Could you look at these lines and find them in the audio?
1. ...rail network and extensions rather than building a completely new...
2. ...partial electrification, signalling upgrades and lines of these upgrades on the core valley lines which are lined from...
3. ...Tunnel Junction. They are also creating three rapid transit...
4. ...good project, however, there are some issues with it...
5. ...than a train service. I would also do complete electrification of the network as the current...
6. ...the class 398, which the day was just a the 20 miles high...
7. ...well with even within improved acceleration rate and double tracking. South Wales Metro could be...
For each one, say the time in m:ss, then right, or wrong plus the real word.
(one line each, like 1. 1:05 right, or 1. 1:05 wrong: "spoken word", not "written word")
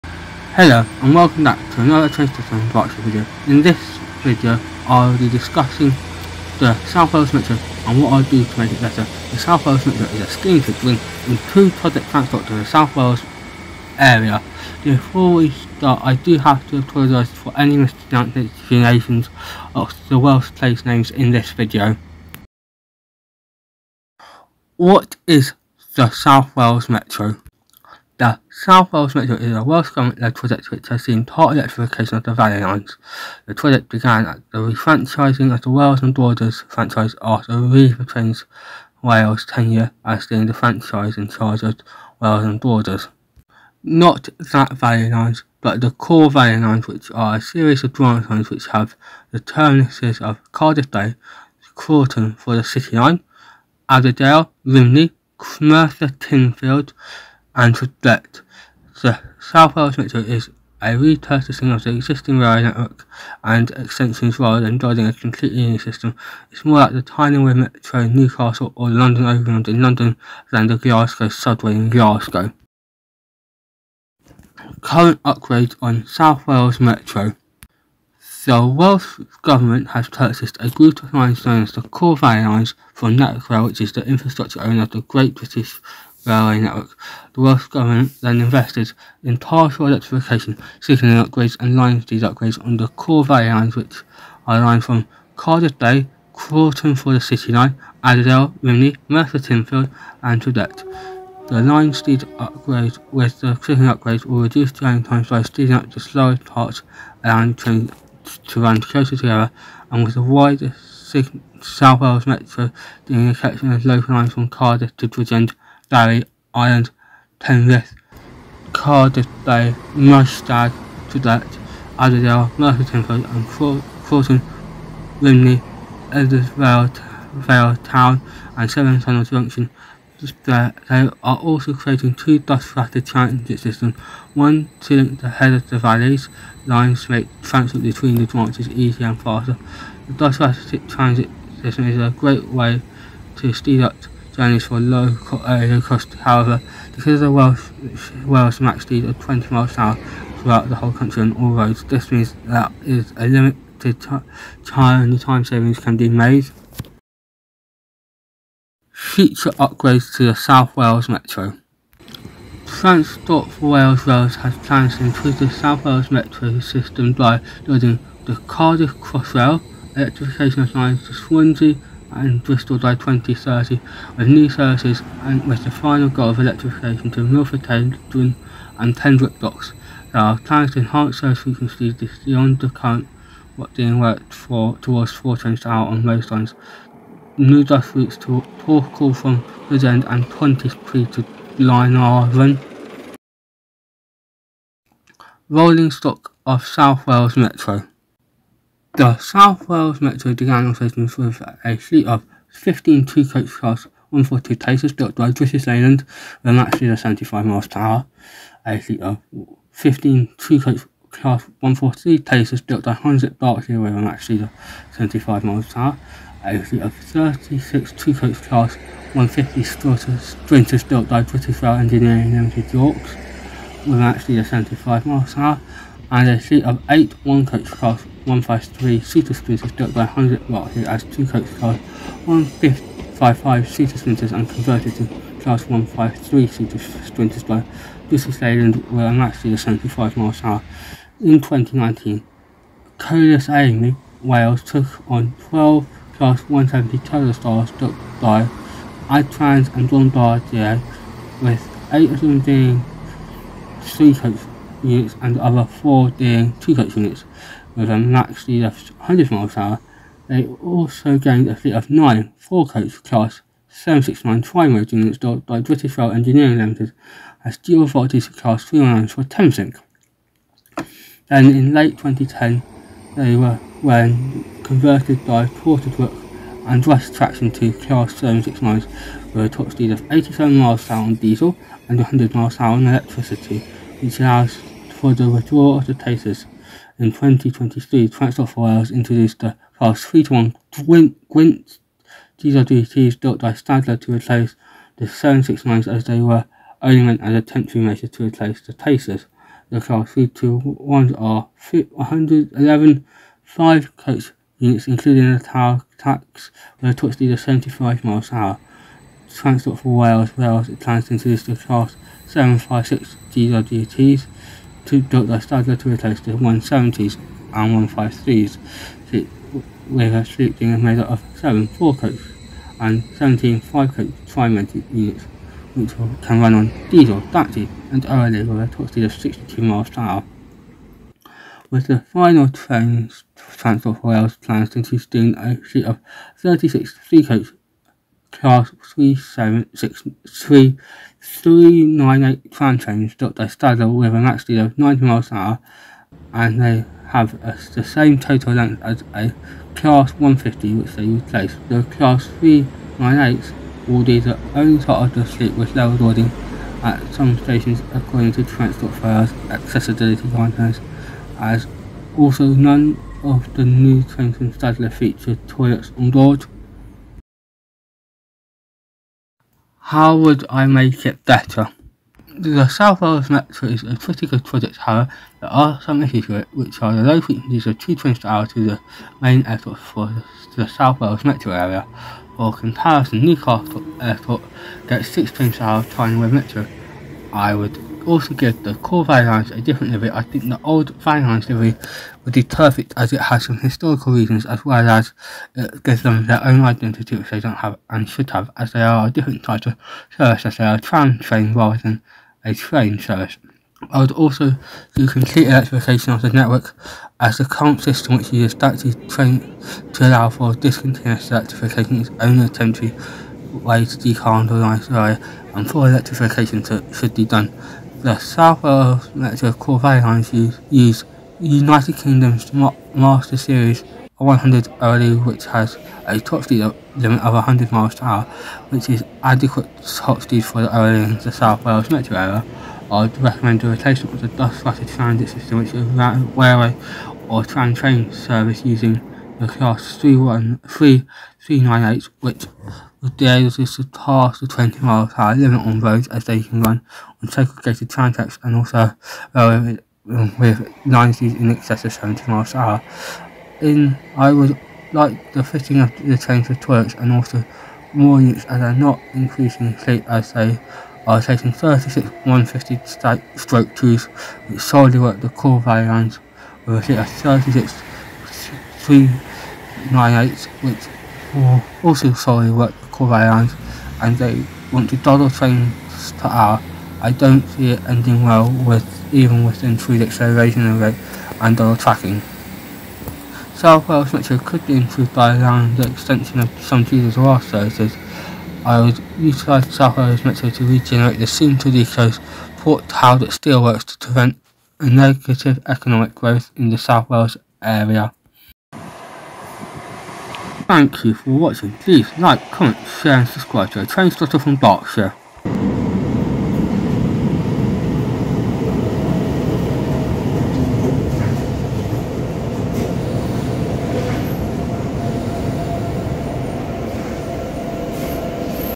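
1. 1:02 right
2. 1:29 right
3. 2:09 wrong: "two", not "three"
4. 6:14 right
5. 6:41 right
6. 7:19 right
7. 7:58 right.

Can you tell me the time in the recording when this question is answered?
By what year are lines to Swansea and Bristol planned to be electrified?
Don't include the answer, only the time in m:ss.
2:52.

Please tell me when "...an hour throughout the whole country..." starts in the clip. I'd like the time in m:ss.
2:29.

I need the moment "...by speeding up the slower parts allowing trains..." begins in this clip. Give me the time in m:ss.
1:45.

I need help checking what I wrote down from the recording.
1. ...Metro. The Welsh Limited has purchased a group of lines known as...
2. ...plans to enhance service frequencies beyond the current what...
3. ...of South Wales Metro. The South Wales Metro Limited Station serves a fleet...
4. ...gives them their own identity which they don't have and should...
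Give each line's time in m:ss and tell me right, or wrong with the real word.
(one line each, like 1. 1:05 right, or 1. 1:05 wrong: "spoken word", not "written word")
1. 1:16 wrong: "Government", not "Limited"
2. 3:00 right
3. 3:16 wrong: "Diagonal", not "Limited"
4. 6:35 right.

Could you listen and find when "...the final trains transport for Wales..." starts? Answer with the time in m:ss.
5:31.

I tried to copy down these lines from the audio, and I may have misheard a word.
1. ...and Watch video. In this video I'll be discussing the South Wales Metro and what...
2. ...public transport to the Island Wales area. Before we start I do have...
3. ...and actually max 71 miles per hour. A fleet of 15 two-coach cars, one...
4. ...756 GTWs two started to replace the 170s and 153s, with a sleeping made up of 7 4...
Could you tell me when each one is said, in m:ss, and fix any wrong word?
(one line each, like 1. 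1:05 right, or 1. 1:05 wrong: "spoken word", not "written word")
1. 0:02 right
2. 0:11 wrong: "South", not "Island"
3. 3:26 wrong: "75", not "71"
4. 5:12 right.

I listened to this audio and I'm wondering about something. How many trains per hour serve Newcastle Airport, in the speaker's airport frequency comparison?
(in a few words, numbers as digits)
6.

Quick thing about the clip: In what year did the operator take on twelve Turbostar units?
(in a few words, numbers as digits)
2019.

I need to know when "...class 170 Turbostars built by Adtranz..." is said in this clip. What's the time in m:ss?
4:06.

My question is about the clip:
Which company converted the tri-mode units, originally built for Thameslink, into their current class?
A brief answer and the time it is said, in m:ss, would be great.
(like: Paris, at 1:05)
Brush Traction, at 4:36.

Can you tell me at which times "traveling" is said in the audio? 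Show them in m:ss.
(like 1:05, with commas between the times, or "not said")
6:25.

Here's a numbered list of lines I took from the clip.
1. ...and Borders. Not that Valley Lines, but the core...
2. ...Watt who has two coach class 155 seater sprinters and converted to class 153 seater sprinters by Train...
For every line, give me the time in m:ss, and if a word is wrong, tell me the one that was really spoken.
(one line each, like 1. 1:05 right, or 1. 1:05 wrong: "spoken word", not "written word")
1. 0:42 right
2. 3:50 wrong: "British", not "Train".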